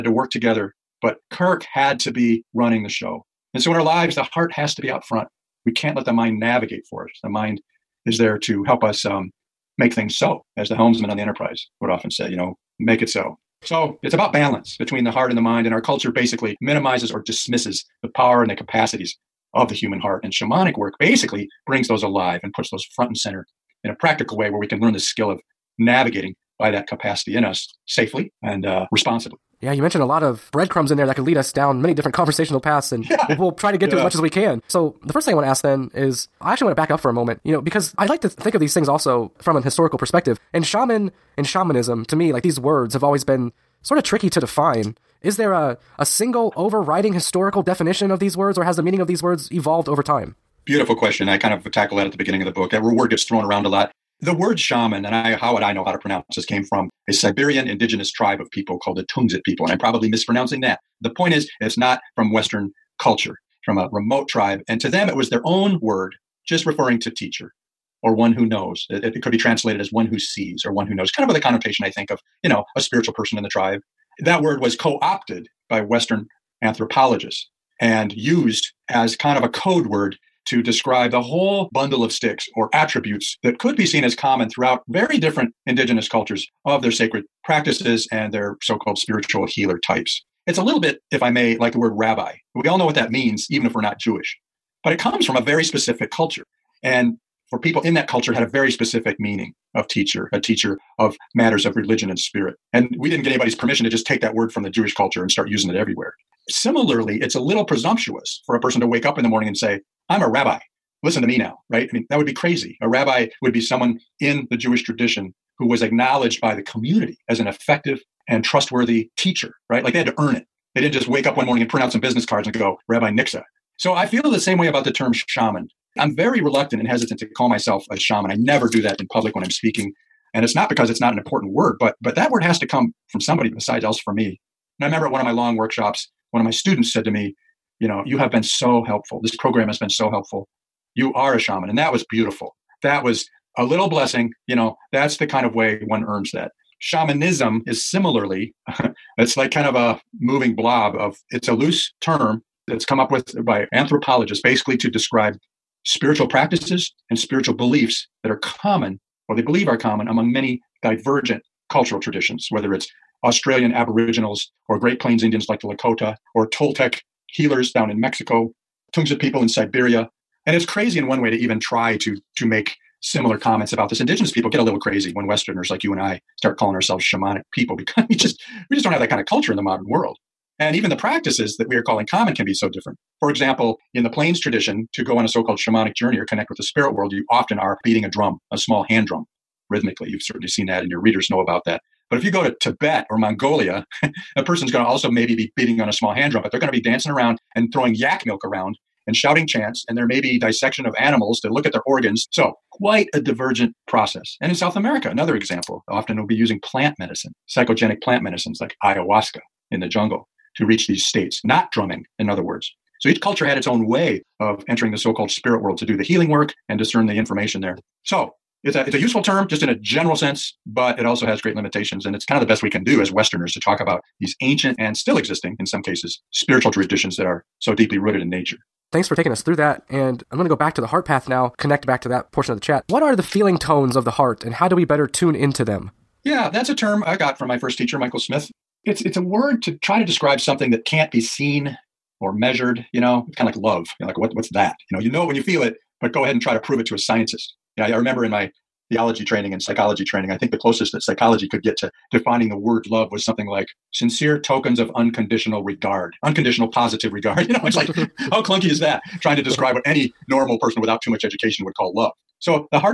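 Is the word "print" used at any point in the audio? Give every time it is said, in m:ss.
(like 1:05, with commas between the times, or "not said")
2:01.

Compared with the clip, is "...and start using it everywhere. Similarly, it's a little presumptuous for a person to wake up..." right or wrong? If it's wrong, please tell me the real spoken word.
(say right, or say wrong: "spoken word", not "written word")
right.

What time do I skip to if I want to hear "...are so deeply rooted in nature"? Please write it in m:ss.
3:47.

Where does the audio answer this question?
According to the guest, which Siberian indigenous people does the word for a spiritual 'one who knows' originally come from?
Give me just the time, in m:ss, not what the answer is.
0:59.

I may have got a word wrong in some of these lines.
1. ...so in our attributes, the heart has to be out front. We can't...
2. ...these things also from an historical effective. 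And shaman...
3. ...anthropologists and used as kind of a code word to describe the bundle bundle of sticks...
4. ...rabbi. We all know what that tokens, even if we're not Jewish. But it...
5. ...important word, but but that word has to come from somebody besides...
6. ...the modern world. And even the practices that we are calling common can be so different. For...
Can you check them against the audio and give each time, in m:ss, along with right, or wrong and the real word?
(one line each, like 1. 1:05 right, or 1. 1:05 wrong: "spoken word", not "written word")
1. 0:03 wrong: "lives", not "attributes"
2. 0:38 wrong: "perspective", not "effective"
3. 1:16 wrong: "whole", not "bundle"
4. 1:31 wrong: "means", not "tokens"
5. 2:11 right
6. 2:59 right.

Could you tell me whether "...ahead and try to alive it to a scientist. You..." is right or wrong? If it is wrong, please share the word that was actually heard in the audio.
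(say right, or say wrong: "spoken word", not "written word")
wrong: "prove", not "alive".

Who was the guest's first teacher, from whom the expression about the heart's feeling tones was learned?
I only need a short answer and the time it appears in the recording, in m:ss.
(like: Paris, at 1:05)
Michael Smith, at 3:57.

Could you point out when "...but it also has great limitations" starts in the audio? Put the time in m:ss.
3:40.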